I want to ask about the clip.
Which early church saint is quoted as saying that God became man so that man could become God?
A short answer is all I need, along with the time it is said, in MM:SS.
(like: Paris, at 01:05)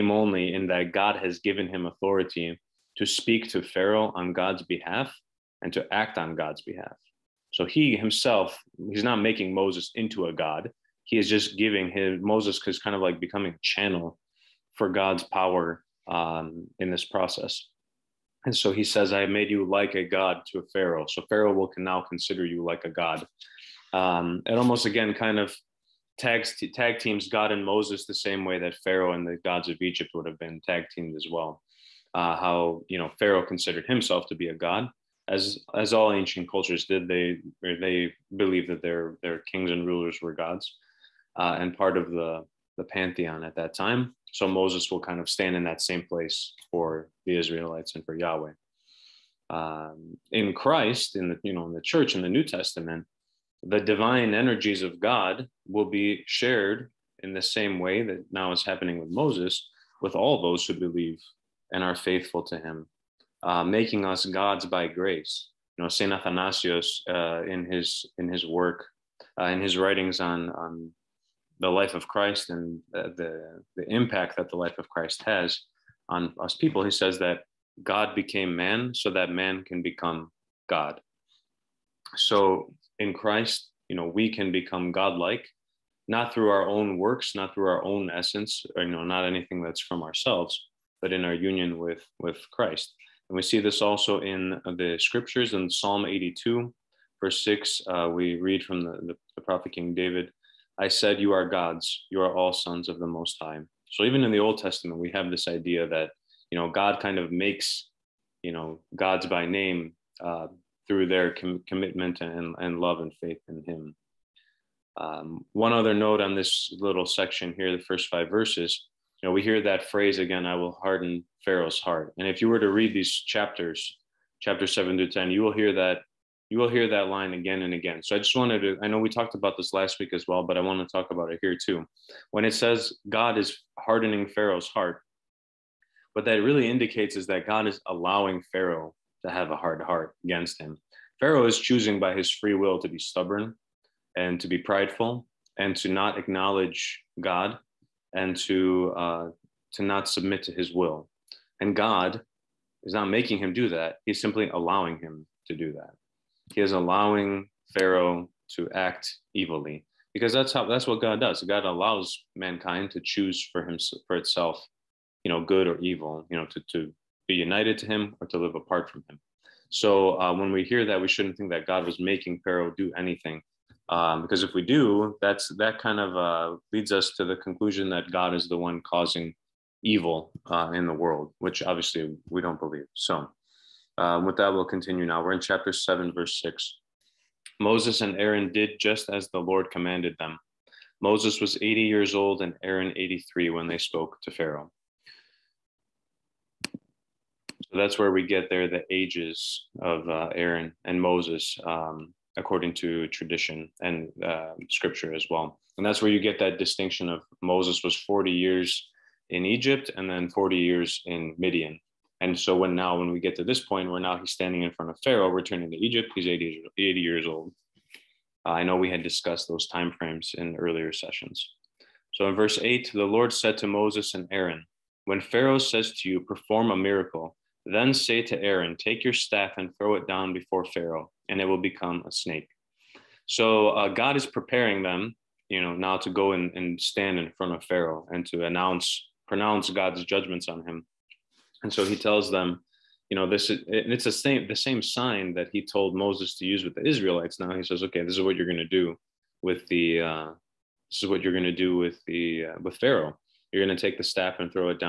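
Saint Athanasius, at 01:05.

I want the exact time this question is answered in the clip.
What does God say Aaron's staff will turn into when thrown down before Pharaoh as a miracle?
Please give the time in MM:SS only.
03:52.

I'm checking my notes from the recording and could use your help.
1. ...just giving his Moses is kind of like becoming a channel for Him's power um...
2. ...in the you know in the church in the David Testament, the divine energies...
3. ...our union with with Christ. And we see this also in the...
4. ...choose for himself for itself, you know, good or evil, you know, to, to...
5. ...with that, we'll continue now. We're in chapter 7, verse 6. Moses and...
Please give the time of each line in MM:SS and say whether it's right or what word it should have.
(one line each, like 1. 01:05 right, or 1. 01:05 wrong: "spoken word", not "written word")
1. 00:11 wrong: "God", not "Him"
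2. 00:51 wrong: "New", not "David"
3. 01:31 right
4. 02:43 right
5. 03:04 right.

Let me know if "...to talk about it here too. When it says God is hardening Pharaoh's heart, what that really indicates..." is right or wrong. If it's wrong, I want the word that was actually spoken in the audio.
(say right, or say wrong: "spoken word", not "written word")
right.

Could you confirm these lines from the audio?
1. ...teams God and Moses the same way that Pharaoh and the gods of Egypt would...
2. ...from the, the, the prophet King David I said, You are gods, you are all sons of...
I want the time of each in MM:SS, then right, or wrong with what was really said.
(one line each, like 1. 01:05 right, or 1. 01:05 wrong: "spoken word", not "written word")
1. 00:26 right
2. 01:38 right.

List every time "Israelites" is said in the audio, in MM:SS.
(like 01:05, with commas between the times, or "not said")
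00:47, 04:06.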